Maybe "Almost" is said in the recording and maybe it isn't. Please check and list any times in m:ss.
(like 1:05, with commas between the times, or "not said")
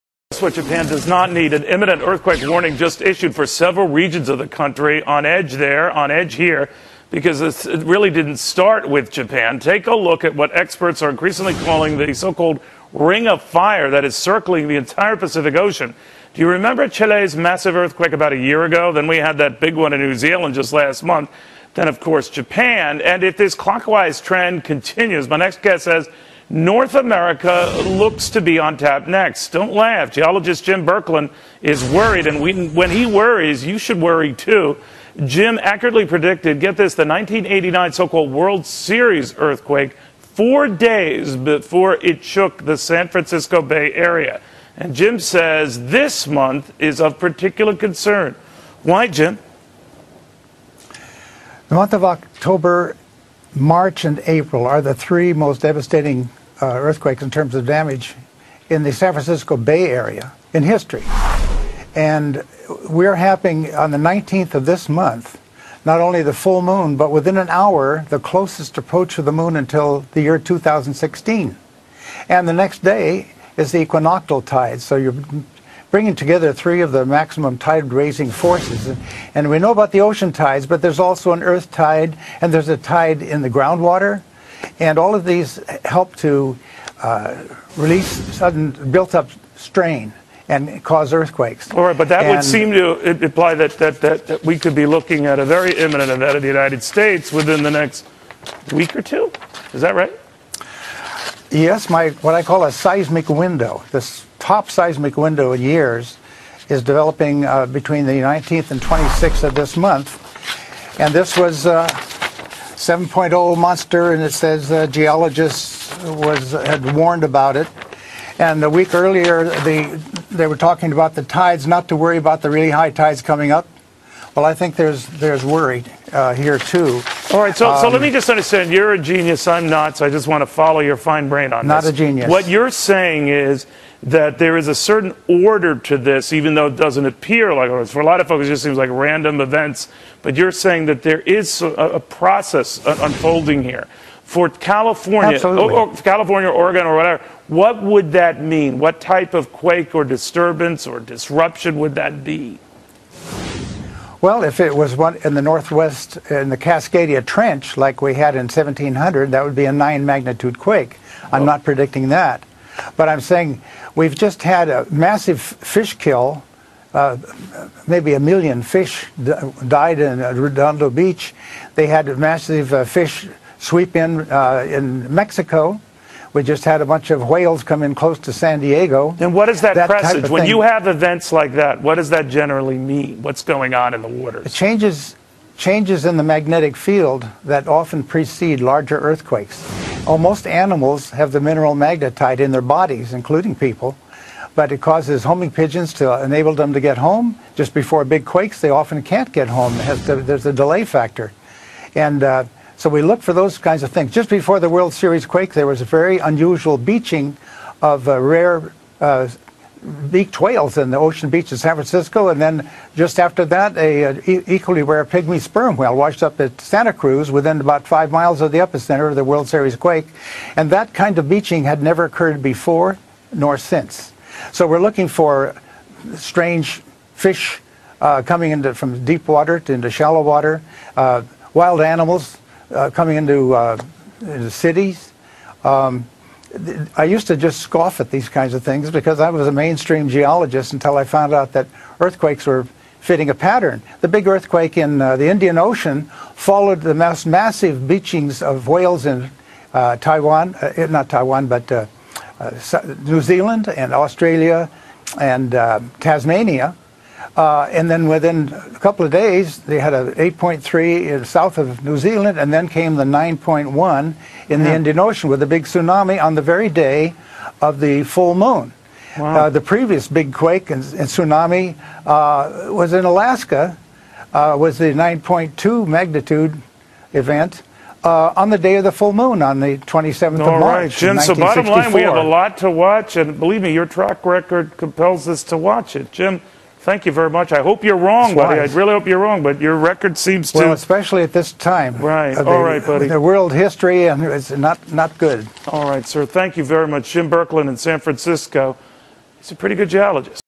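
3:10.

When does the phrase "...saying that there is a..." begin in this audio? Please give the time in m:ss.
2:20.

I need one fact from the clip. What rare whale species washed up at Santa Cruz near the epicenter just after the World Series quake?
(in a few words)
pygmy sperm whale.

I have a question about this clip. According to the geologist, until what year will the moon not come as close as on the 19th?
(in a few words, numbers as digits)
2016.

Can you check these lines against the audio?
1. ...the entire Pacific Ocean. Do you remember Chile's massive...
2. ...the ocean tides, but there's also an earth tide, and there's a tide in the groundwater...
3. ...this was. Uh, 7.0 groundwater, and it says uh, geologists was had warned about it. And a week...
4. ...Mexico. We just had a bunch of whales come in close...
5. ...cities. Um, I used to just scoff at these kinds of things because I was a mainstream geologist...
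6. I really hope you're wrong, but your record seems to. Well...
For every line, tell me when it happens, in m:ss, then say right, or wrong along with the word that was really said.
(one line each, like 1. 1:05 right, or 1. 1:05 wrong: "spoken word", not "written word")
1. 0:14 right
2. 1:19 right
3. 1:51 wrong: "monster", not "groundwater"
4. 2:55 right
5. 3:54 right
6. 4:48 right.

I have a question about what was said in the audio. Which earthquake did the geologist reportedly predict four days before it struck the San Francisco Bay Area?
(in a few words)
1989 World Series earthquake.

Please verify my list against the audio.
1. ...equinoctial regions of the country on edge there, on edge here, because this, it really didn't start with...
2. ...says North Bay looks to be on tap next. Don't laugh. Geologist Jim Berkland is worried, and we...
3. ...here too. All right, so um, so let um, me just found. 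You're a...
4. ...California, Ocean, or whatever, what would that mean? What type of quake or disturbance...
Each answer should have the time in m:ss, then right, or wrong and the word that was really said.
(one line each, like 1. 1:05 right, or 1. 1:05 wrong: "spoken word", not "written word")
1. 0:03 wrong: "several", not "equinoctial"
2. 0:25 wrong: "America", not "Bay"
3. 2:06 wrong: "understand", not "found"
4. 2:26 wrong: "Oregon", not "Ocean".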